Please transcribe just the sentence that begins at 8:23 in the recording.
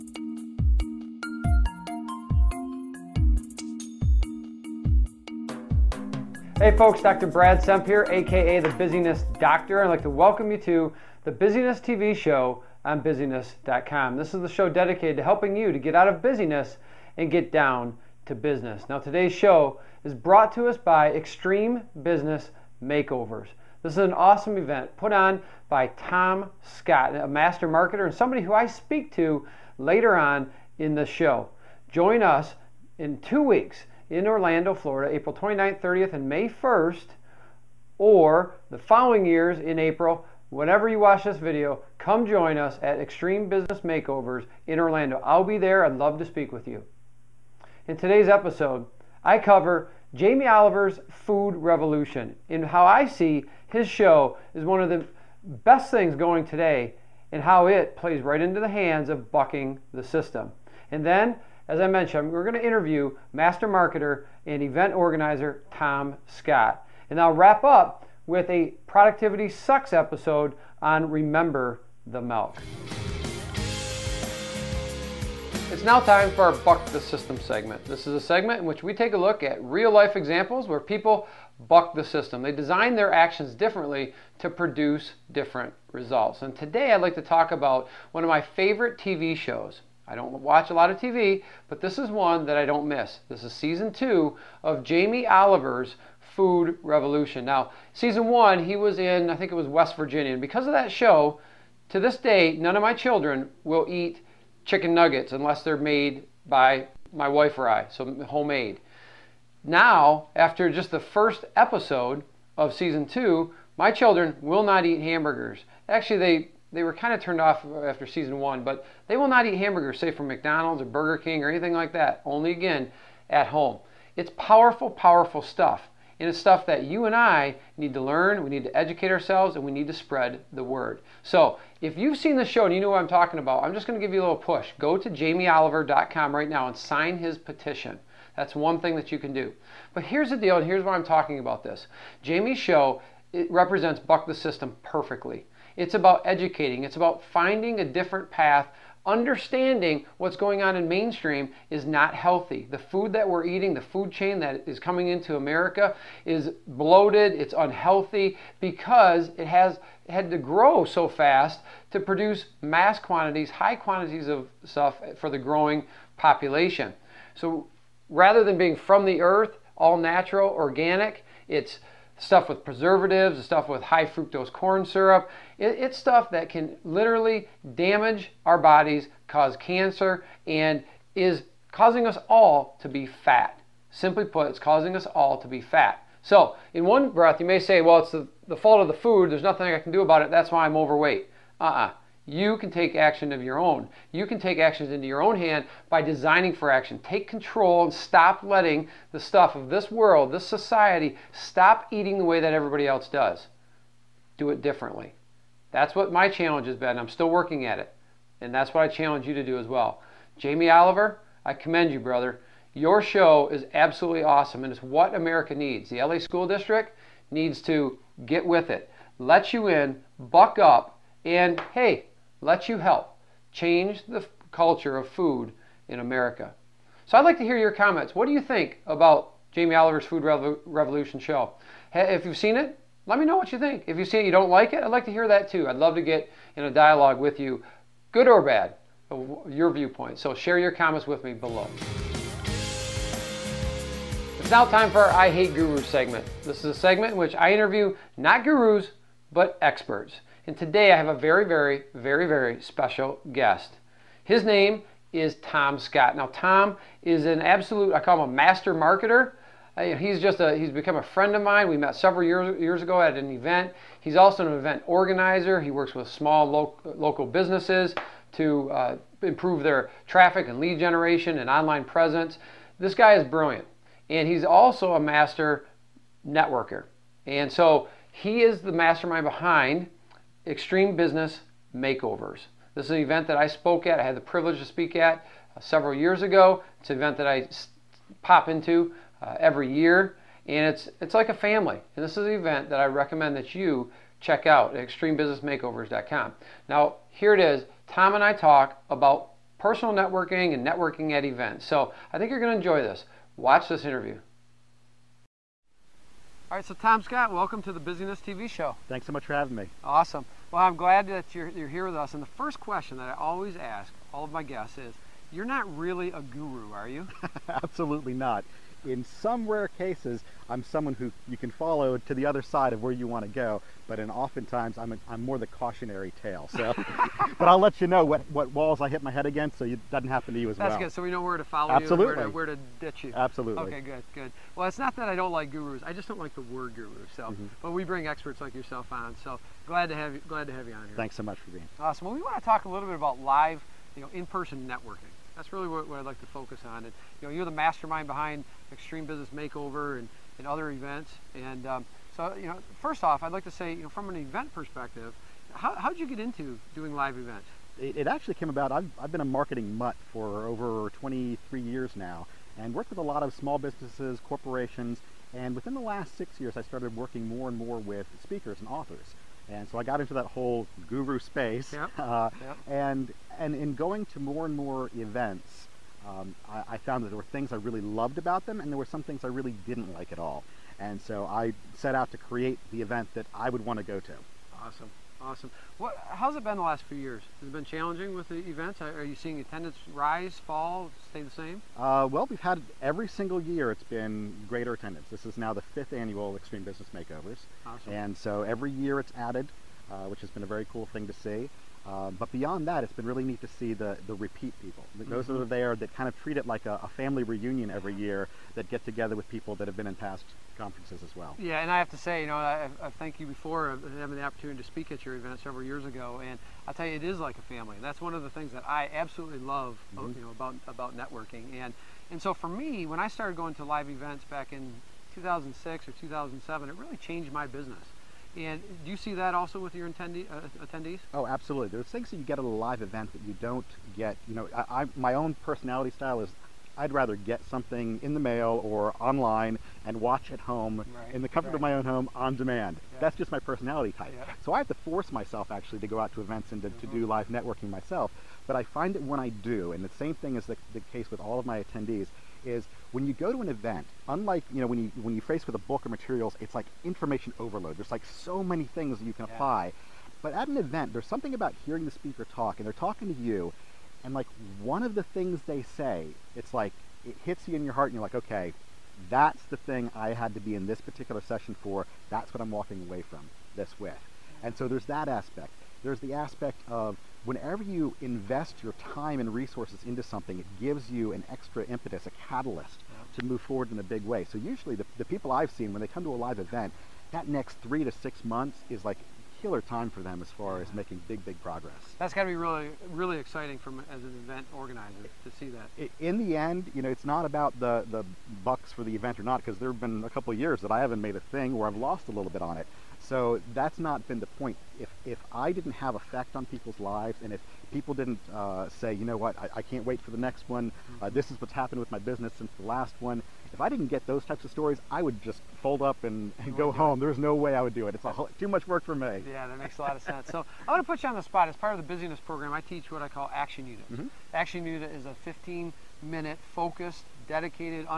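So that's not been the point.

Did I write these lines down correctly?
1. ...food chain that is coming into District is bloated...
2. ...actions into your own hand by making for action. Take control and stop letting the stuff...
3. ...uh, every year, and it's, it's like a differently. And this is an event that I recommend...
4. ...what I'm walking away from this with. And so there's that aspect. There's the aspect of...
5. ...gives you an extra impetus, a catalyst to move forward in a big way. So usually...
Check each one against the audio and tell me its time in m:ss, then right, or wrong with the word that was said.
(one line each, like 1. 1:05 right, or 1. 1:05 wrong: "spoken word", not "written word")
1. 2:33 wrong: "America", not "District"
2. 3:14 wrong: "designing", not "making"
3. 4:49 wrong: "family", not "differently"
4. 7:52 right
5. 8:00 right.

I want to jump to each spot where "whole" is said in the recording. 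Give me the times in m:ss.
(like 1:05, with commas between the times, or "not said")
6:10, 8:38.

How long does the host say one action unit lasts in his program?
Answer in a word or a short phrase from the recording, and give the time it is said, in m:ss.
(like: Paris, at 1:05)
15 minutes, at 8:45.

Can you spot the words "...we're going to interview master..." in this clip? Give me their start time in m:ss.
1:02.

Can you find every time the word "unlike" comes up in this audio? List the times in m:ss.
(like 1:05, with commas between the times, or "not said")
7:34.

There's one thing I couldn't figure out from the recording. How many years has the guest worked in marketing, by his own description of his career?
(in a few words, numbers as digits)
23.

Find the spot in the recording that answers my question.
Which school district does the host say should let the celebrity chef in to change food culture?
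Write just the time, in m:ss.
3:35.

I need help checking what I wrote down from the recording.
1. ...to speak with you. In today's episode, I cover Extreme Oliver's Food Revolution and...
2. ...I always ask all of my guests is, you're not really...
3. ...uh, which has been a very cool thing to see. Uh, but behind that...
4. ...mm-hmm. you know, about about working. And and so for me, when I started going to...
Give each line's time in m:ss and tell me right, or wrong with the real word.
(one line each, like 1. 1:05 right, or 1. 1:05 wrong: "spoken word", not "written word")
1. 0:46 wrong: "Jamie", not "Extreme"
2. 5:13 right
3. 6:39 wrong: "beyond", not "behind"
4. 7:00 wrong: "networking", not "working".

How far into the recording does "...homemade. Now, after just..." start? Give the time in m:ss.
1:48.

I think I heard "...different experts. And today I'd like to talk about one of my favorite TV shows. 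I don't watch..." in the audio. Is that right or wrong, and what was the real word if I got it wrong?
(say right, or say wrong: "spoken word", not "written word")
wrong: "results", not "experts".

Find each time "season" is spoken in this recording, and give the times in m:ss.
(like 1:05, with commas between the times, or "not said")
1:33, 1:37, 1:52, 1:58.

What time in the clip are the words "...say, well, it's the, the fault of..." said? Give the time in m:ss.
3:07.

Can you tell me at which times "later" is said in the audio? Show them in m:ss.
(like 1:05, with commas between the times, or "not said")
0:29.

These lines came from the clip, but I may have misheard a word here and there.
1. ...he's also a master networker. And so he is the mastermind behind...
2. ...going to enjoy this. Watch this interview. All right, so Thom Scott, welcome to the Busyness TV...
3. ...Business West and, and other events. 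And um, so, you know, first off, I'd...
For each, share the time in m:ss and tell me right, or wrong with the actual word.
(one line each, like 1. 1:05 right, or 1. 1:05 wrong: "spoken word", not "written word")
1. 4:34 right
2. 5:02 right
3. 5:49 wrong: "Makeover", not "West".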